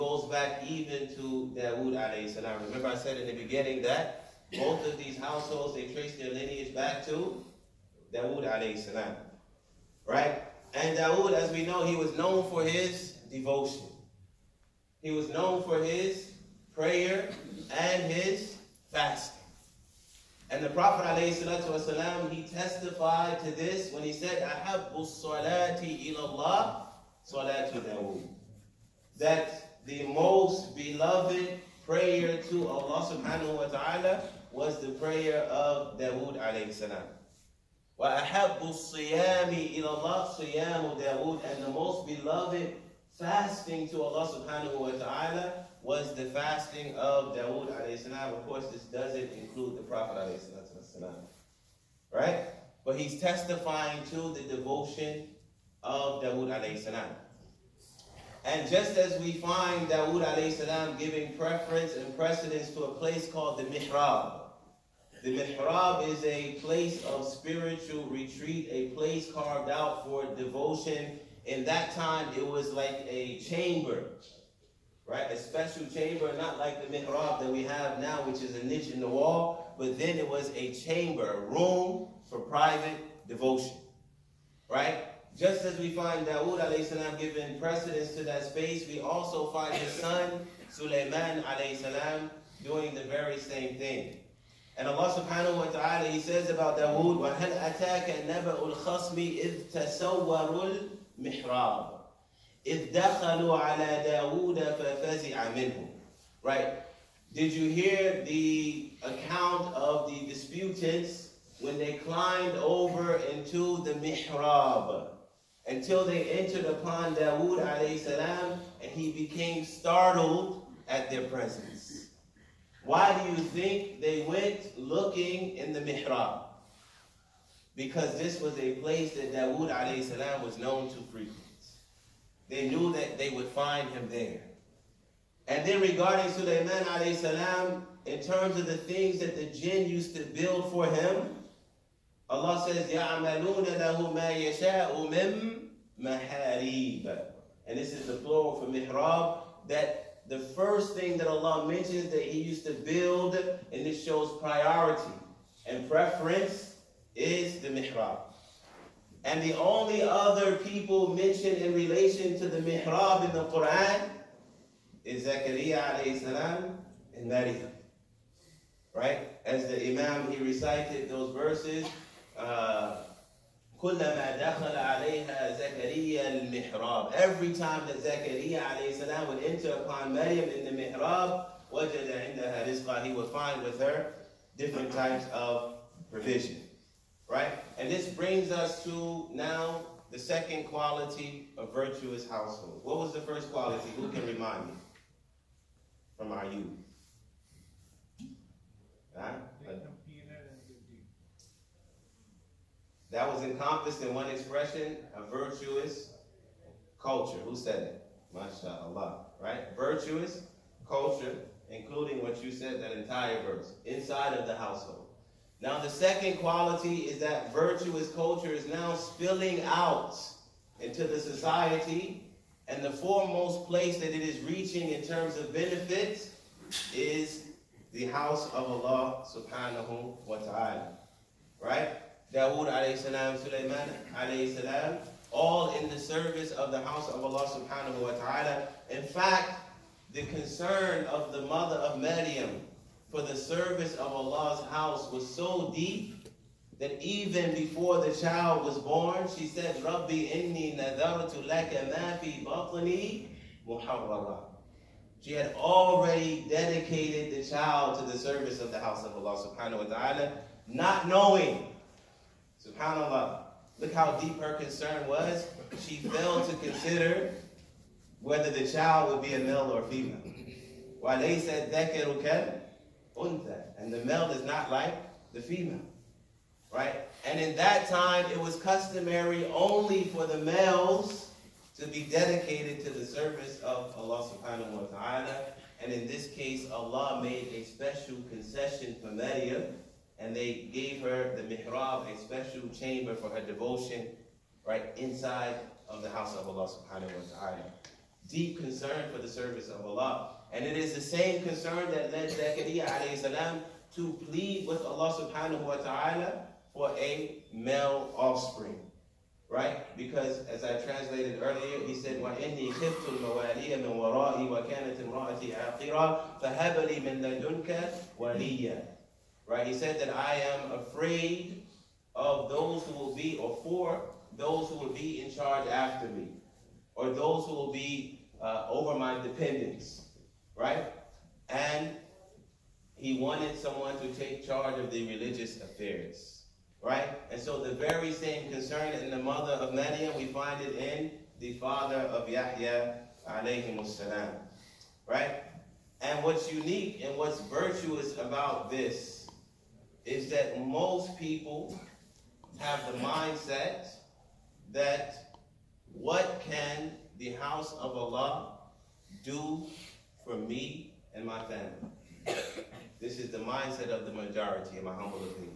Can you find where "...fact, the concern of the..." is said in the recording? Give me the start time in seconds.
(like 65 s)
239 s.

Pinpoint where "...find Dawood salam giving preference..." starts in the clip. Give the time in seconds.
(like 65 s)
59 s.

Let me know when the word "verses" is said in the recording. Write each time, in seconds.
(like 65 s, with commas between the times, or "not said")
171 s, 213 s.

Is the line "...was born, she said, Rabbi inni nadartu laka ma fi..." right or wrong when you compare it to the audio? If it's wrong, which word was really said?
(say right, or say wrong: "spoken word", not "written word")
right.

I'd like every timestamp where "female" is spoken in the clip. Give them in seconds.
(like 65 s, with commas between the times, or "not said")
269 s, 275 s.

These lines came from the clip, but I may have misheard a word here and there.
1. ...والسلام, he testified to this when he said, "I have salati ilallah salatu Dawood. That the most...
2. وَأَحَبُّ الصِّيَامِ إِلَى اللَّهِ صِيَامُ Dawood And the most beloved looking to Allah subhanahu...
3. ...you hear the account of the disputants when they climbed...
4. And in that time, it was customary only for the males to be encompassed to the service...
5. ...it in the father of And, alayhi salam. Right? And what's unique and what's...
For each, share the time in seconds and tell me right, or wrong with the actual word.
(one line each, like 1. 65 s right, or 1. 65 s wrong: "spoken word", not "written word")
1. 21 s right
2. 37 s wrong: "fasting", not "looking"
3. 107 s right
4. 277 s wrong: "dedicated", not "encompassed"
5. 340 s wrong: "Yahya", not "And".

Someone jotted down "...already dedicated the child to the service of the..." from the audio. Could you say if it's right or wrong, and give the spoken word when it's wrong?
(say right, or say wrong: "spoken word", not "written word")
right.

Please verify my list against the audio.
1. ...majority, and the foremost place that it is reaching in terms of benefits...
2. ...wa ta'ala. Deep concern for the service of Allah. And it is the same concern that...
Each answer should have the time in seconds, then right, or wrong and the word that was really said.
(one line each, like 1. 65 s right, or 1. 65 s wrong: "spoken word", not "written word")
1. 221 s wrong: "society", not "majority"
2. 297 s right.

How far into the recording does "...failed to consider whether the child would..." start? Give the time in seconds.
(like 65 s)
265 s.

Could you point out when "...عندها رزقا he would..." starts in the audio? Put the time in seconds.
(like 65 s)
182 s.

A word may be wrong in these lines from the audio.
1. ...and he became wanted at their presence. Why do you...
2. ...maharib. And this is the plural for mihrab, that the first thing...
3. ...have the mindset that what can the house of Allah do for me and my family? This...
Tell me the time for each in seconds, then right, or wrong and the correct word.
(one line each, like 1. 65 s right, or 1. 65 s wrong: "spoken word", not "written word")
1. 118 s wrong: "startled", not "wanted"
2. 146 s right
3. 352 s right.